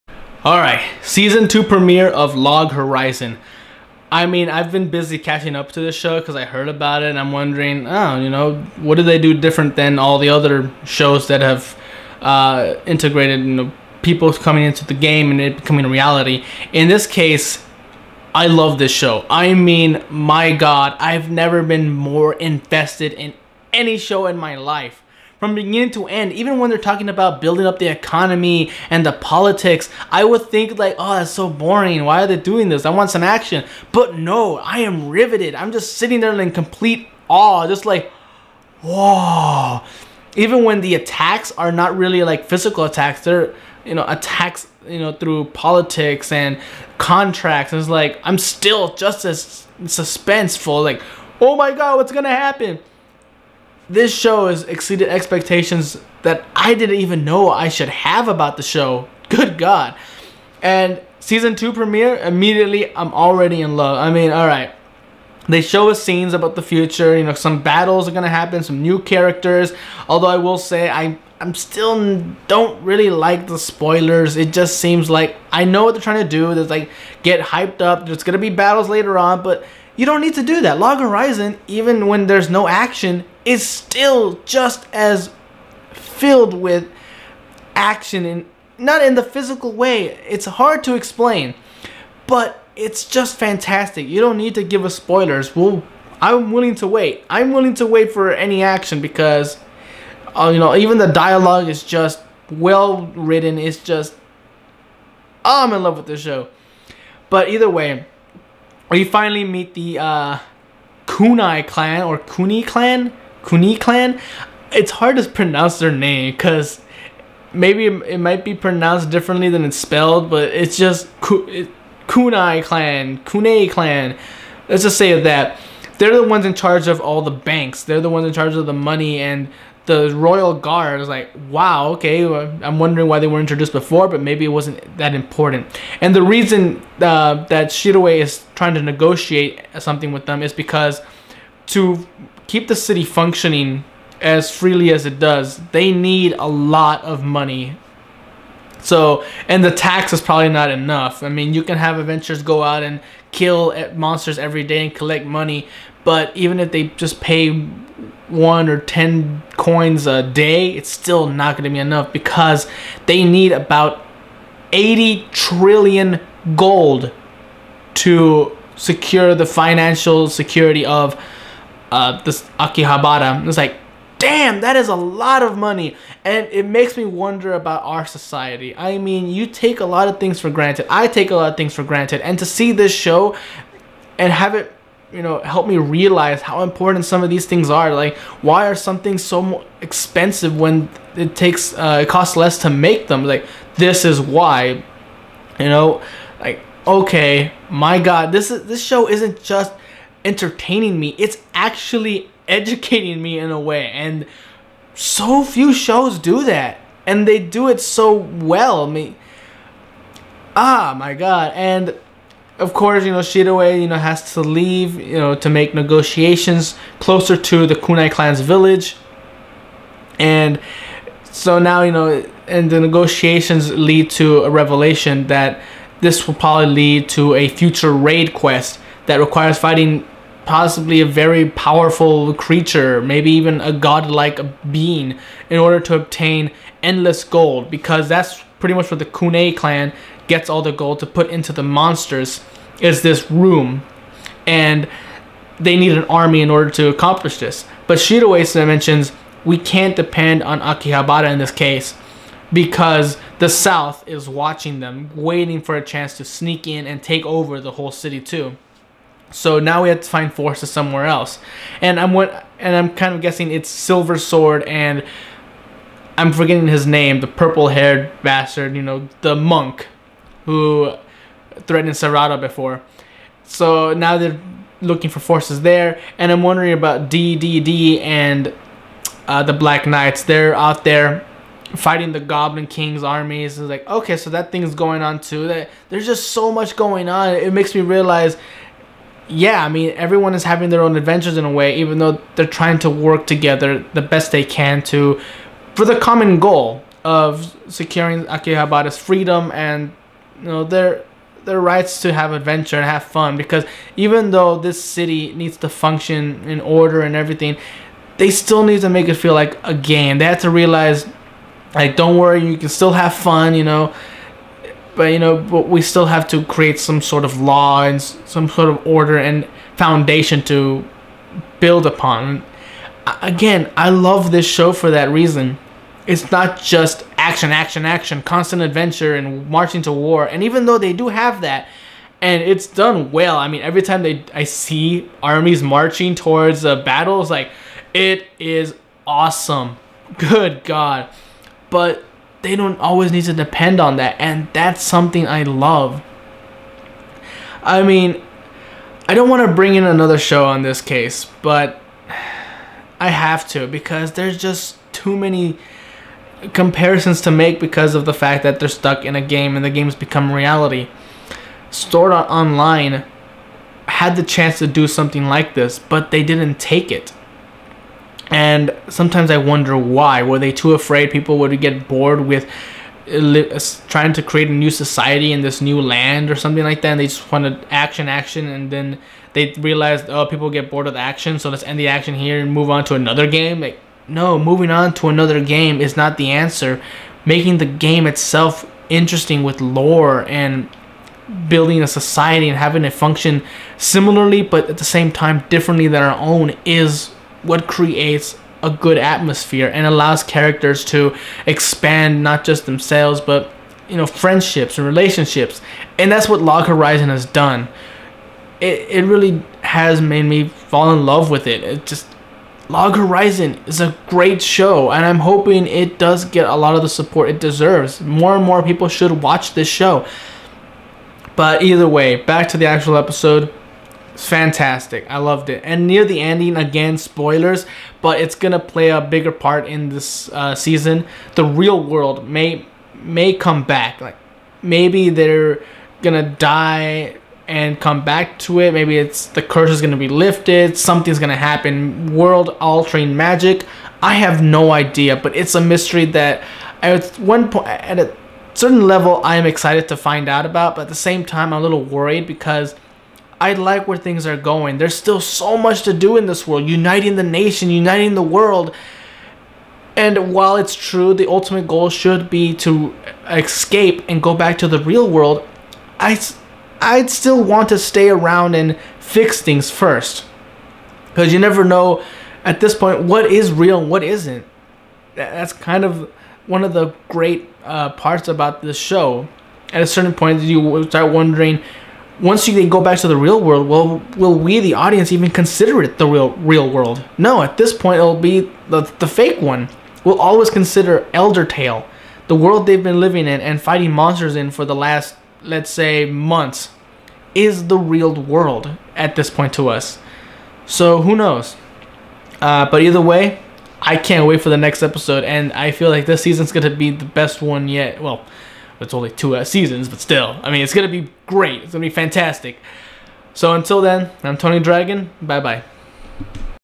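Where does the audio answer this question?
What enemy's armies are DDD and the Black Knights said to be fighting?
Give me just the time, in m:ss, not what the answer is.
4:42.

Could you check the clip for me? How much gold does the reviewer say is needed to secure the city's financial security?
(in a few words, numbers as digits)
80 trillion gold.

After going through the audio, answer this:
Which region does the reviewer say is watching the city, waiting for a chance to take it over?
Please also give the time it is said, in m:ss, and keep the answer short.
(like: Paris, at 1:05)
The South, at 4:13.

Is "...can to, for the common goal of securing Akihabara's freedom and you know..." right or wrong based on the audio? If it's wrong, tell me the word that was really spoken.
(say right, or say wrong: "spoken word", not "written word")
right.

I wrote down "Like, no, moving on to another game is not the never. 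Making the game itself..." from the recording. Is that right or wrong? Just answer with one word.
wrong.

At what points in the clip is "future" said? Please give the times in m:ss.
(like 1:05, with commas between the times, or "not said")
1:06, 3:47.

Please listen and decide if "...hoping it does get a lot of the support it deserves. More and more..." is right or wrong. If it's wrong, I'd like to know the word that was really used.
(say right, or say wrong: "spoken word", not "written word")
right.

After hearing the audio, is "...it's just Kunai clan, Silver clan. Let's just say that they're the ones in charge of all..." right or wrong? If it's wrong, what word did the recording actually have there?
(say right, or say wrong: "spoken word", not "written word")
wrong: "Kunai", not "Silver".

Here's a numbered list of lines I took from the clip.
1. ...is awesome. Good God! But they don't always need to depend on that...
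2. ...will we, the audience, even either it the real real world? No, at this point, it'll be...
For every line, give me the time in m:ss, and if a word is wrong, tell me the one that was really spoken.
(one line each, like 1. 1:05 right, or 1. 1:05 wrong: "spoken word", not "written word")
1. 5:38 right
2. 8:04 wrong: "consider", not "either".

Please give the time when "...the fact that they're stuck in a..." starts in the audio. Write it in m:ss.
5:58.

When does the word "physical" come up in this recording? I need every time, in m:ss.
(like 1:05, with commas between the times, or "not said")
0:42, 1:29.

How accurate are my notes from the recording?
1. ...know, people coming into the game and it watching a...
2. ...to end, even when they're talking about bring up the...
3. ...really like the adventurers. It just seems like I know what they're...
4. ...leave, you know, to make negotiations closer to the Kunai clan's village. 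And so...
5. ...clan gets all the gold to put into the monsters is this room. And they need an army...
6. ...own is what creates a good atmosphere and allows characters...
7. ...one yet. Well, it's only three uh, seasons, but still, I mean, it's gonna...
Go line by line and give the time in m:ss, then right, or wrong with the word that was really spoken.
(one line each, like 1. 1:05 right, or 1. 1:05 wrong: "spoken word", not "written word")
1. 0:13 wrong: "becoming", not "watching"
2. 0:25 wrong: "building", not "bring"
3. 1:12 wrong: "spoilers", not "adventurers"
4. 3:34 right
5. 3:59 right
6. 6:36 right
7. 8:27 wrong: "two", not "three".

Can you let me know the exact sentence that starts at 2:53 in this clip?
It's like, damn, that is a lot of money.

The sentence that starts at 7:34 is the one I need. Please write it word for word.
There's still so much to do in this world, uniting the nation, uniting the world.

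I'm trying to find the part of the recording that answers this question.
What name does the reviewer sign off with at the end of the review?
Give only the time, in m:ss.
8:34.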